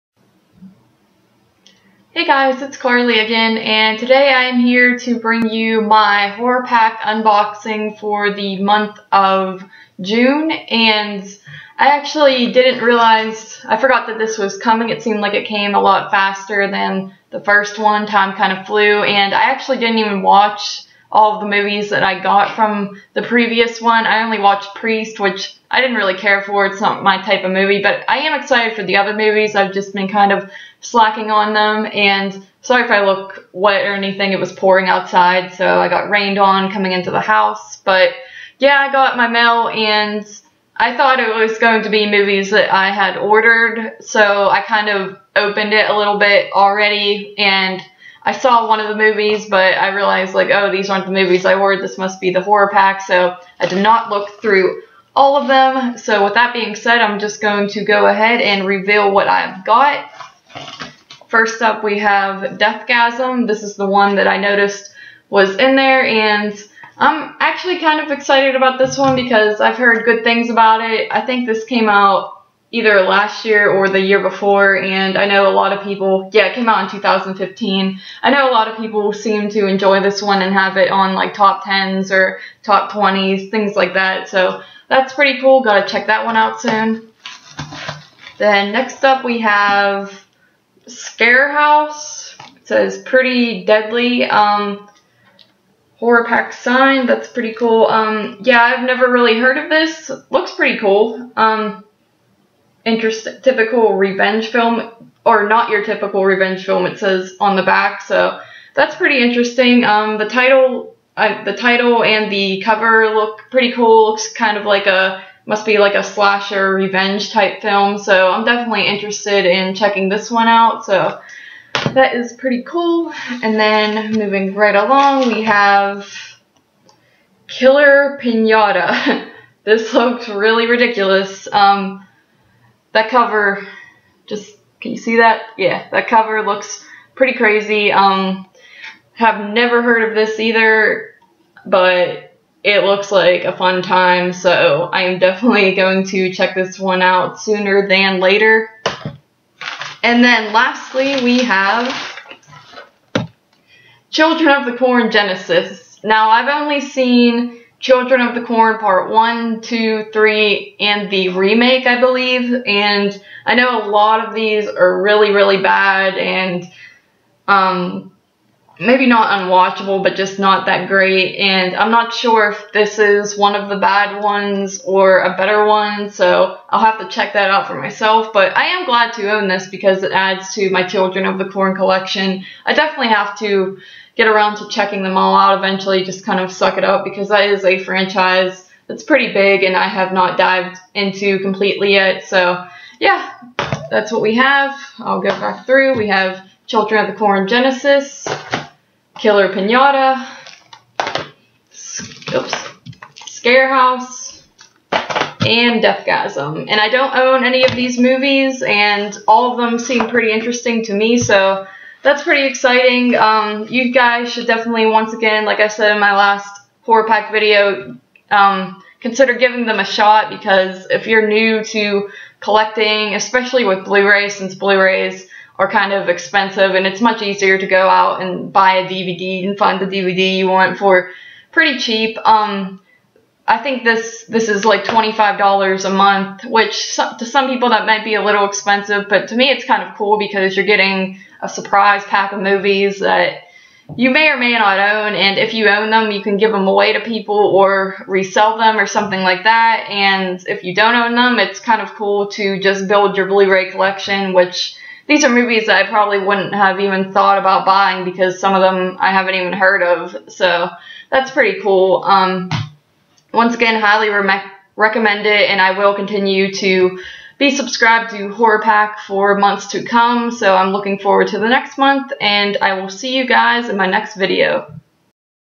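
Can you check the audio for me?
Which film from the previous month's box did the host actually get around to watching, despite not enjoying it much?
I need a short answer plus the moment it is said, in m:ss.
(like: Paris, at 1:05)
Priest, at 0:24.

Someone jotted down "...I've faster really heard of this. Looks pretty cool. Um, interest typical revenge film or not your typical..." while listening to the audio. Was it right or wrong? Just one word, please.
wrong.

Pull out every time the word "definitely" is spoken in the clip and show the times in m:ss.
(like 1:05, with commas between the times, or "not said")
1:58, 2:25, 3:02, 3:34.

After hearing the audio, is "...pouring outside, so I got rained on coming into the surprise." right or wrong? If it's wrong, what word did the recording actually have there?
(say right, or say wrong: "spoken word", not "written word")
wrong: "house", not "surprise".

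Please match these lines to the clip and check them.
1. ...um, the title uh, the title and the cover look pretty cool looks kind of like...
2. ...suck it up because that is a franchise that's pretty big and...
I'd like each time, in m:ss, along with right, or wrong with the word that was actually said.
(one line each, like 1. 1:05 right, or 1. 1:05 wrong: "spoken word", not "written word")
1. 1:49 right
2. 3:06 right.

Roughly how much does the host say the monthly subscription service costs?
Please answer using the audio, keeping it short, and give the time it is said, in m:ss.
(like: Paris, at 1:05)
$25, at 3:54.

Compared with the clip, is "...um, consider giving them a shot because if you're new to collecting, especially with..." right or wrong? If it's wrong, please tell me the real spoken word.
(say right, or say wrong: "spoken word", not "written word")
right.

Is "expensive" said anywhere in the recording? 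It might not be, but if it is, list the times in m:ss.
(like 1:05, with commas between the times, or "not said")
3:46, 3:58.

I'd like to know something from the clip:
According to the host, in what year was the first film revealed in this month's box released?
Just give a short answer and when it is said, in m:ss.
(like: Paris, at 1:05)
2015, at 1:16.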